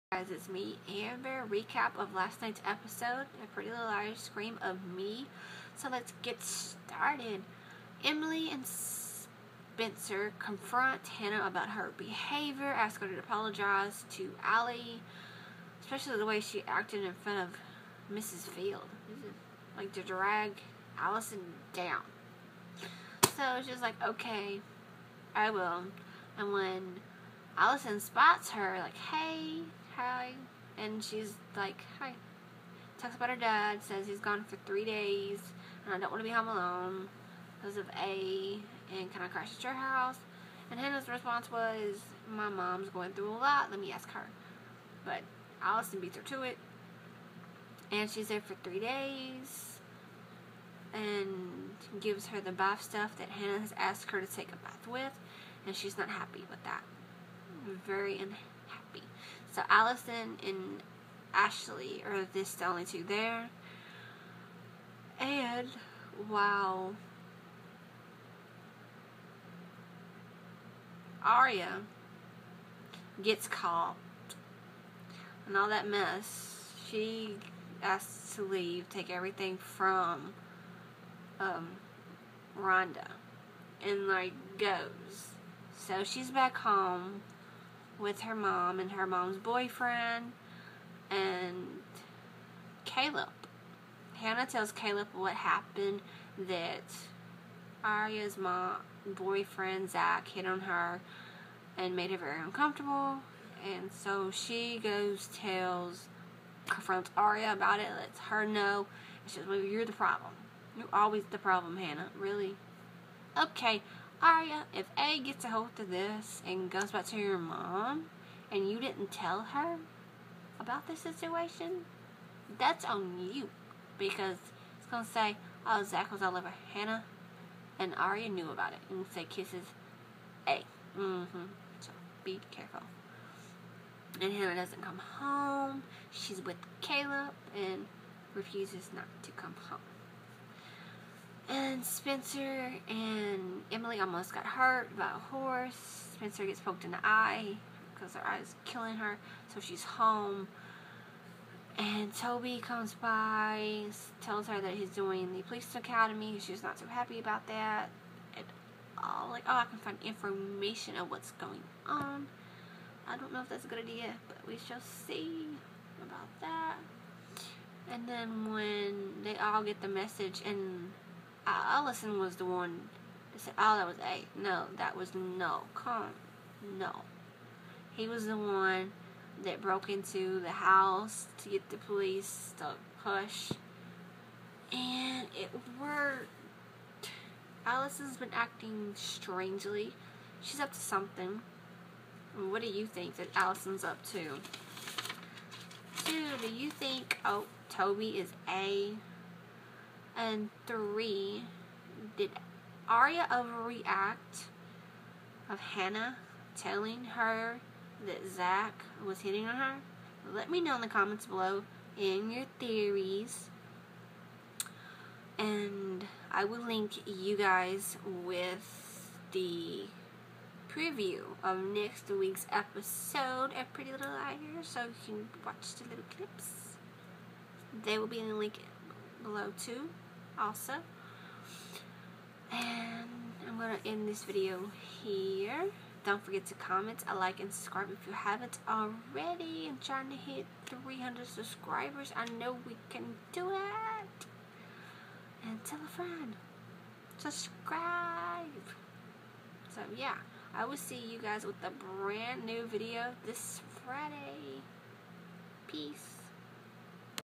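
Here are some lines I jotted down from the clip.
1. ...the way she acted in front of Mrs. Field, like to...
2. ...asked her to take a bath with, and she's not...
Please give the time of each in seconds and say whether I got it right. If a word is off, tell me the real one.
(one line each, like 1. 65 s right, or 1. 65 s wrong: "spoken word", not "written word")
1. 16 s right
2. 53 s right.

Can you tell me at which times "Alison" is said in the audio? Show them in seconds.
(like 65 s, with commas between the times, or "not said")
20 s, 27 s, 45 s, 59 s, 171 s, 187 s, 193 s.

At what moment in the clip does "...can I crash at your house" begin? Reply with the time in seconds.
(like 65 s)
39 s.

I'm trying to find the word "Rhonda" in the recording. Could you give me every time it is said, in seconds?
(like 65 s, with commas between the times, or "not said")
82 s.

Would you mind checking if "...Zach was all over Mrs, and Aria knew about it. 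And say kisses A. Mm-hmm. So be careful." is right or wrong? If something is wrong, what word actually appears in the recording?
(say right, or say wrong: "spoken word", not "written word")
wrong: "Hanna", not "Mrs".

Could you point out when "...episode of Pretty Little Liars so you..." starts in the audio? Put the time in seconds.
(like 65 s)
222 s.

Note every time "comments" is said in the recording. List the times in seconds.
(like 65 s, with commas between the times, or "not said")
210 s, 236 s.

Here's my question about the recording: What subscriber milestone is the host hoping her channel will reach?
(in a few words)
300.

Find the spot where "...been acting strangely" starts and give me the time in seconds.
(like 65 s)
188 s.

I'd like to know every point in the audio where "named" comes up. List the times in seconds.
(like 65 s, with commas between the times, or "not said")
not said.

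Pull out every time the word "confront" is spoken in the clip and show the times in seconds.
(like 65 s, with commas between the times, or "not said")
10 s, 106 s.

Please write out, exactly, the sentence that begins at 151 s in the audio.
And Toby comes by, tells her that he's doing the police academy.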